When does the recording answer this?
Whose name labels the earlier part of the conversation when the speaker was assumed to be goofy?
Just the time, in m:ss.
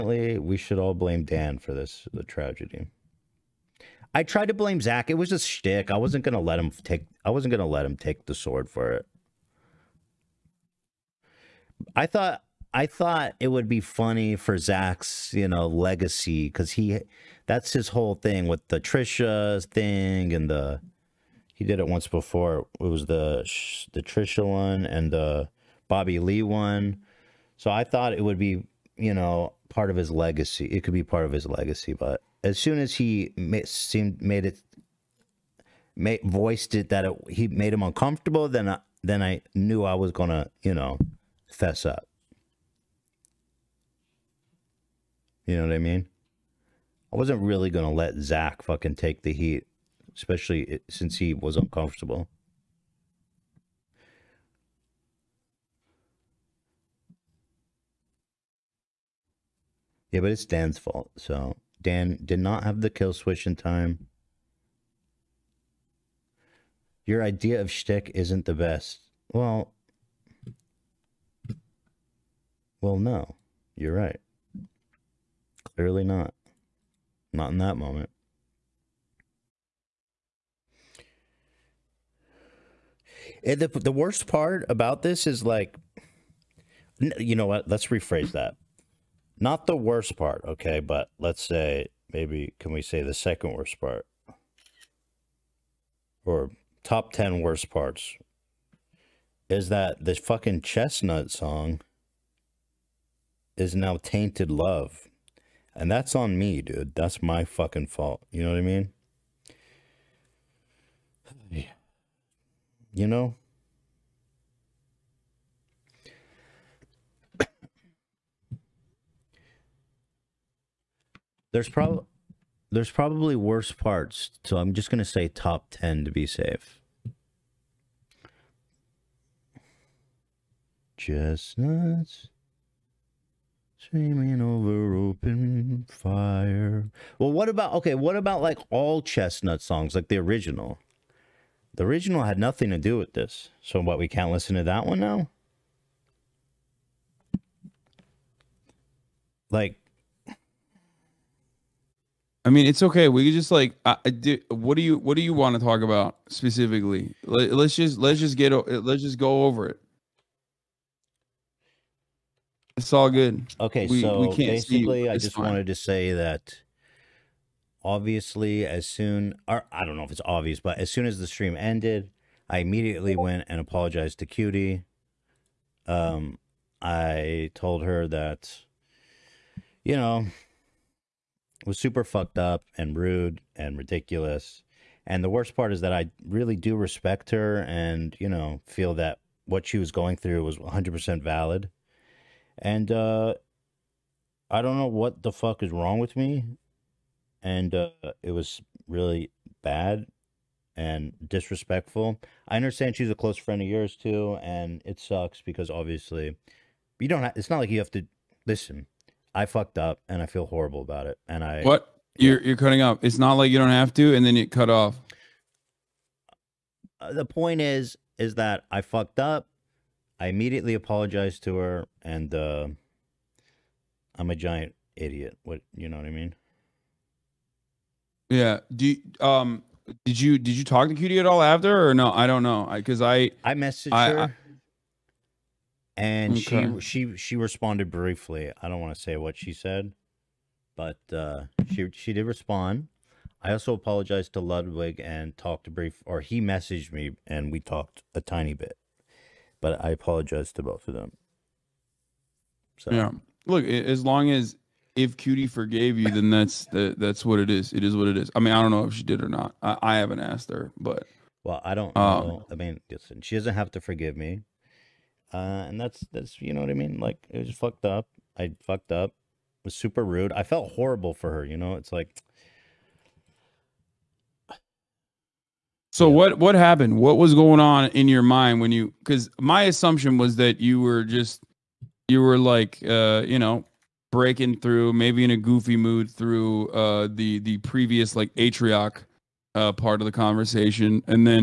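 4:48.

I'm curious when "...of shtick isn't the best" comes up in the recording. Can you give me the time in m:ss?
1:07.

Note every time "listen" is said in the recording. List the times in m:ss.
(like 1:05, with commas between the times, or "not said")
2:24, 3:28, 4:22.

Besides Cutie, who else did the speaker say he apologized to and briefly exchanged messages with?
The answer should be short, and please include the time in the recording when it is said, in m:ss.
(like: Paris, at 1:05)
Ludwig, at 4:04.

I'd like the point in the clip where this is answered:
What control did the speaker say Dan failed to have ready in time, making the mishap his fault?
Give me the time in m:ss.
1:02.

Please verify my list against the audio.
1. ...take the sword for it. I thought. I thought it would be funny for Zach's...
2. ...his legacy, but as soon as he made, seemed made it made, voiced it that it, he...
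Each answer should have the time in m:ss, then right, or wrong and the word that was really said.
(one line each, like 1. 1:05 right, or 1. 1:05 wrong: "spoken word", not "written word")
1. 0:07 right
2. 0:31 right.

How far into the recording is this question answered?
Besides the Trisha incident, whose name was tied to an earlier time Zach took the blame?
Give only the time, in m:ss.
0:25.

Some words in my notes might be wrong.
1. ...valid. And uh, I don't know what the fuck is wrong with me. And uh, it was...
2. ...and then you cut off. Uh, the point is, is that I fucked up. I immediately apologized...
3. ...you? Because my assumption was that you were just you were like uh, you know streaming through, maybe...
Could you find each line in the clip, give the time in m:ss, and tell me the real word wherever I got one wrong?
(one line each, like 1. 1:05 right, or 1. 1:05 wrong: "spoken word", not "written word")
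1. 3:11 right
2. 3:34 right
3. 4:38 wrong: "breaking", not "streaming".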